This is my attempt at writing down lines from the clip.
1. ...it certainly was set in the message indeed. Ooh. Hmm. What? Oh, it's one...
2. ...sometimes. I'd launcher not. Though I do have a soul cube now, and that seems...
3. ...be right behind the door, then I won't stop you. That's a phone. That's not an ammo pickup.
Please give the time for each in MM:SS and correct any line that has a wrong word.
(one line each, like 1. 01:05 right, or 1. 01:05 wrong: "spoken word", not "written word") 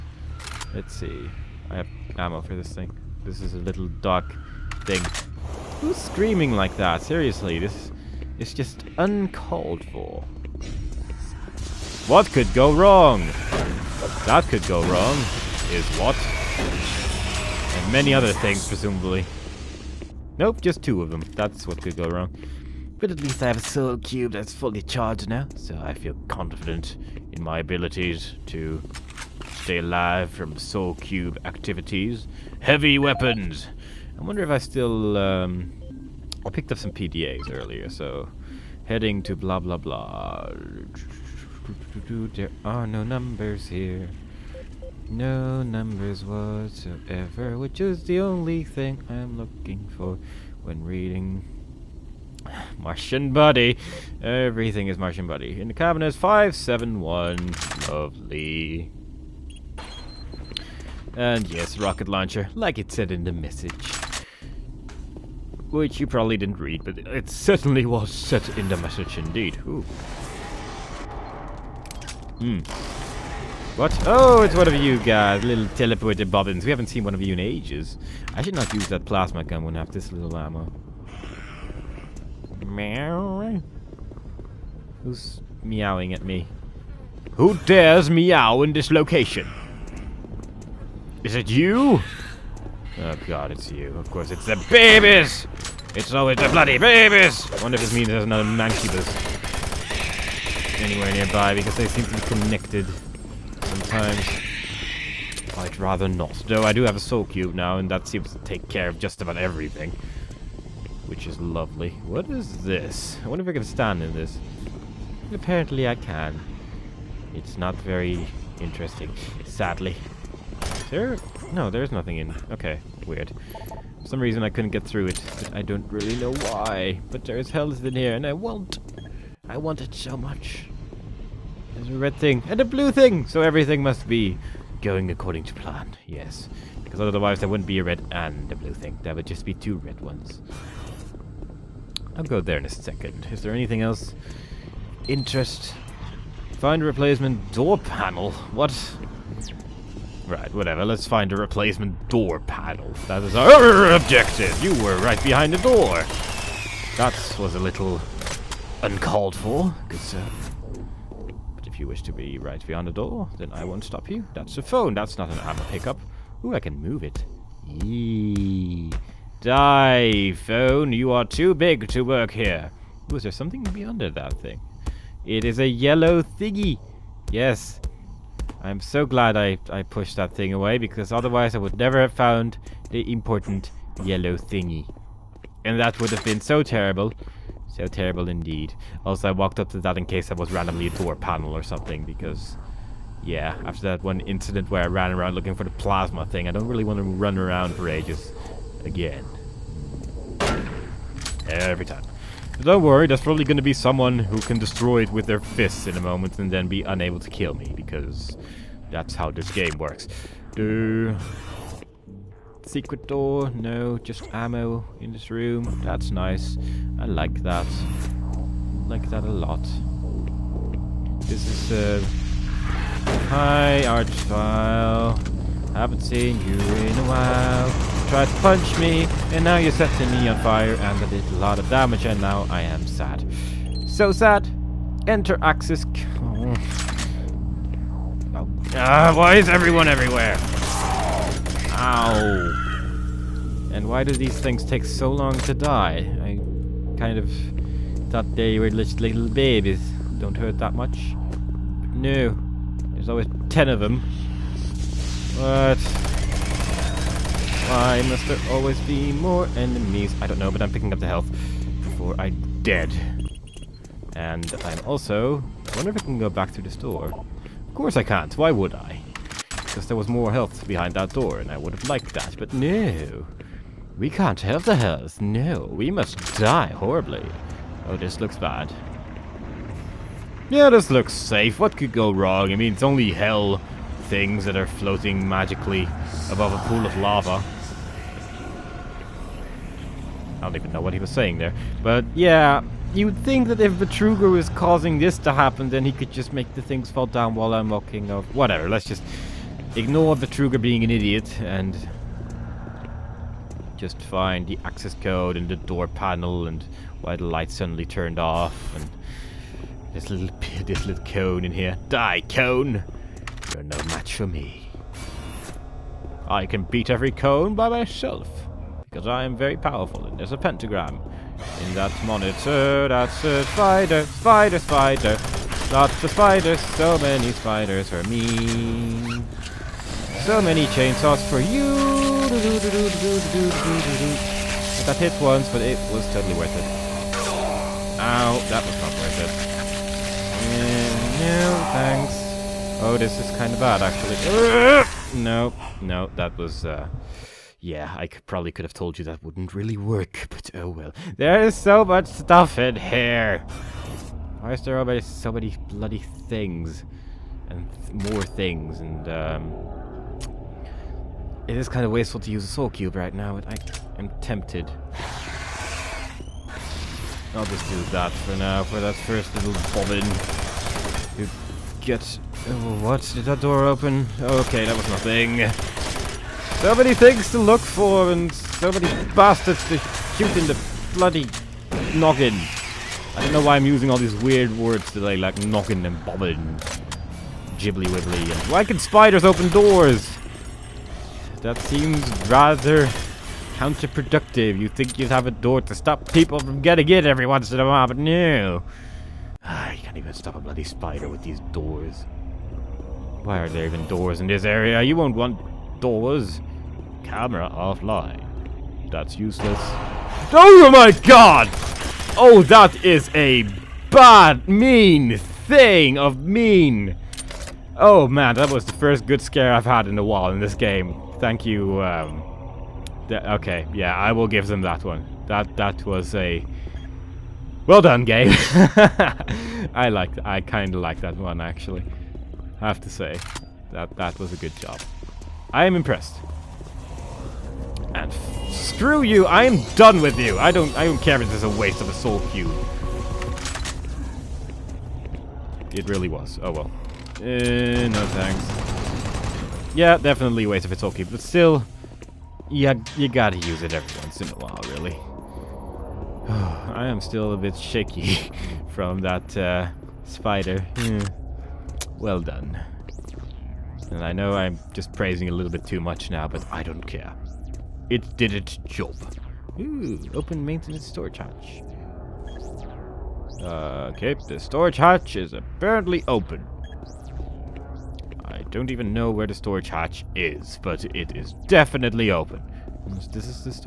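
1. 01:06 right
2. 01:43 wrong: "rather", not "launcher"
3. 02:42 right.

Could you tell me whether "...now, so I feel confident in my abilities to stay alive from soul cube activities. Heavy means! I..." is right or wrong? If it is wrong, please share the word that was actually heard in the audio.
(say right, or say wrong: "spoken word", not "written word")
wrong: "weapons", not "means".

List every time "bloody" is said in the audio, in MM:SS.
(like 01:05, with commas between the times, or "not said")
01:36, 05:55, 06:20, 06:40.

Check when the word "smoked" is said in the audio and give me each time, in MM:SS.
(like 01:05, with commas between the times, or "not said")
not said.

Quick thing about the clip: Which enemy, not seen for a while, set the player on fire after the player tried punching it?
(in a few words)
Arch-vile.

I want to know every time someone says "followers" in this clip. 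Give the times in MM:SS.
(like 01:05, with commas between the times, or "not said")
not said.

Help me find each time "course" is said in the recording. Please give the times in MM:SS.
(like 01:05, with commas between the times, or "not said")
01:34, 04:27.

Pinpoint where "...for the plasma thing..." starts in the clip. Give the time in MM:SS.
03:15.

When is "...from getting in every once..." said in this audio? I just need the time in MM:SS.
06:36.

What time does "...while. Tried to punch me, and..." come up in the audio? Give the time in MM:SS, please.
03:47.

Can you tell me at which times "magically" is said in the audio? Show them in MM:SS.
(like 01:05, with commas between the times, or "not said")
04:45.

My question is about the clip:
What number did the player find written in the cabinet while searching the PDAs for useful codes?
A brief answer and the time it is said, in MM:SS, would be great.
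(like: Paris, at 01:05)
571, at 00:56.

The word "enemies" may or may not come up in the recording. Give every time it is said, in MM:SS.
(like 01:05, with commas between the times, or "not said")
04:19.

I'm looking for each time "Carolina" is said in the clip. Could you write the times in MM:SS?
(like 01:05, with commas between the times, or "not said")
not said.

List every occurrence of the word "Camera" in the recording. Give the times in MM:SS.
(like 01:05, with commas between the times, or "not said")
06:47.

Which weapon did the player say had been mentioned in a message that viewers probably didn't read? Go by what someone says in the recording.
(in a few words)
Rocket launcher.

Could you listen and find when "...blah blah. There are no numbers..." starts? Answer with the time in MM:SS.
00:39.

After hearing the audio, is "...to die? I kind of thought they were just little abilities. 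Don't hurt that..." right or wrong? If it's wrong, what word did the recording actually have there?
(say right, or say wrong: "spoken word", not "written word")
wrong: "babies", not "abilities".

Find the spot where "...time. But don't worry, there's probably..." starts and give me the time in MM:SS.
03:21.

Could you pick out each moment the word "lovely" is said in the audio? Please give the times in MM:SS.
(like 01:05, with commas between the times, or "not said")
00:57, 01:51.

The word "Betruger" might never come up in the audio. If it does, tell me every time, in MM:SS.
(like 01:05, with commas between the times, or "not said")
04:53, 05:00.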